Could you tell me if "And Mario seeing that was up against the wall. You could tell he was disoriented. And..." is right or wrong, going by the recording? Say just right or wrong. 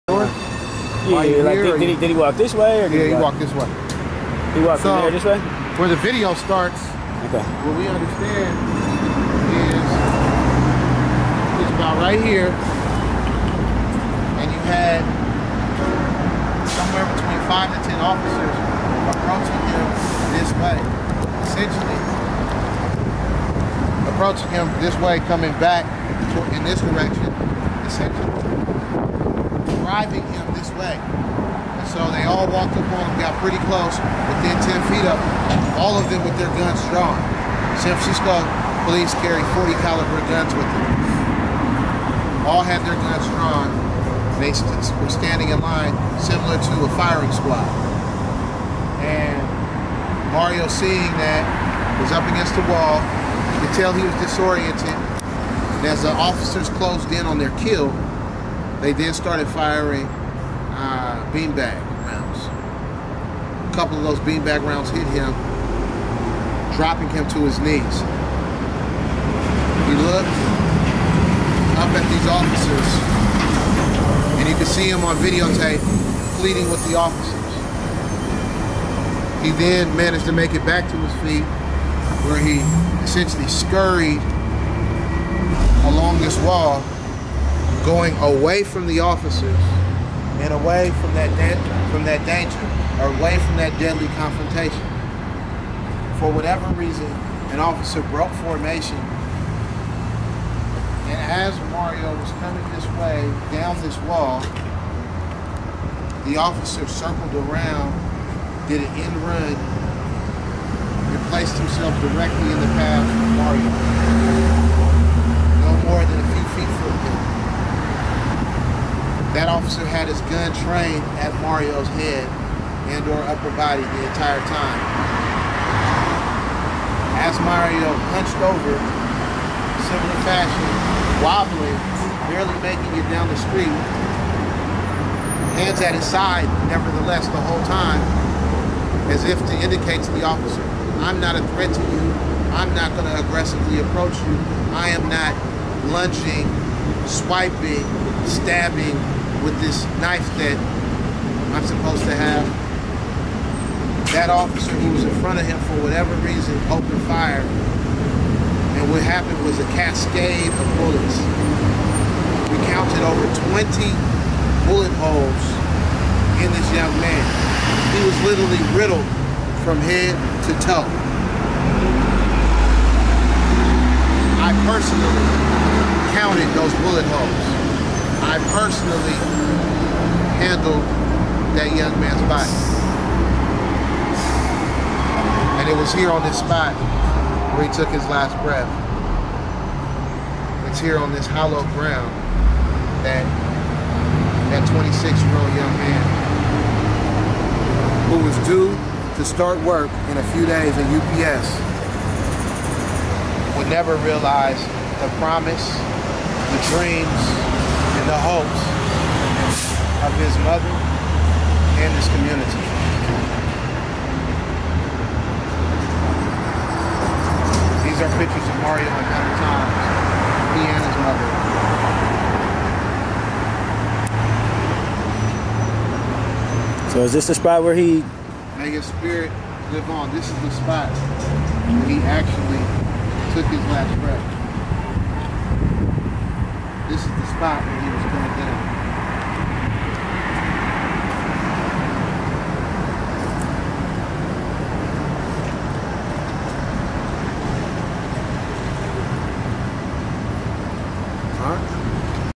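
right.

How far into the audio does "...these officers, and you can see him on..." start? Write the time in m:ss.
1:12.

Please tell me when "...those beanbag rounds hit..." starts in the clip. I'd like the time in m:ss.
1:04.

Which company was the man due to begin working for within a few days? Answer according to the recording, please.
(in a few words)
UPS.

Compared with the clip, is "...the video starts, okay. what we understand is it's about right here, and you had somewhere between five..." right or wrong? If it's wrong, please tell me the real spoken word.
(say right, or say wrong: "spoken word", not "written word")
right.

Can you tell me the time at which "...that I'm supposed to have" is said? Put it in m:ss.
2:30.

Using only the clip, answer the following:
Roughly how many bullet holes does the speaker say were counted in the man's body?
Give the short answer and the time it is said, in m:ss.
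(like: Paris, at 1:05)
Over 20, at 2:43.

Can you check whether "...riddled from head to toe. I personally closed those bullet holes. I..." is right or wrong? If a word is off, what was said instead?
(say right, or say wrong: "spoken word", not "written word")
wrong: "counted", not "closed".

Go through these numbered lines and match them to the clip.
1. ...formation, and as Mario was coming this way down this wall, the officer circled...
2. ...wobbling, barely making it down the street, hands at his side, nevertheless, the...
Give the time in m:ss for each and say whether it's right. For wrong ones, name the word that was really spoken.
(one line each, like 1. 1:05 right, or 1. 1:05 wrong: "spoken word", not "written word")
1. 1:38 right
2. 2:11 right.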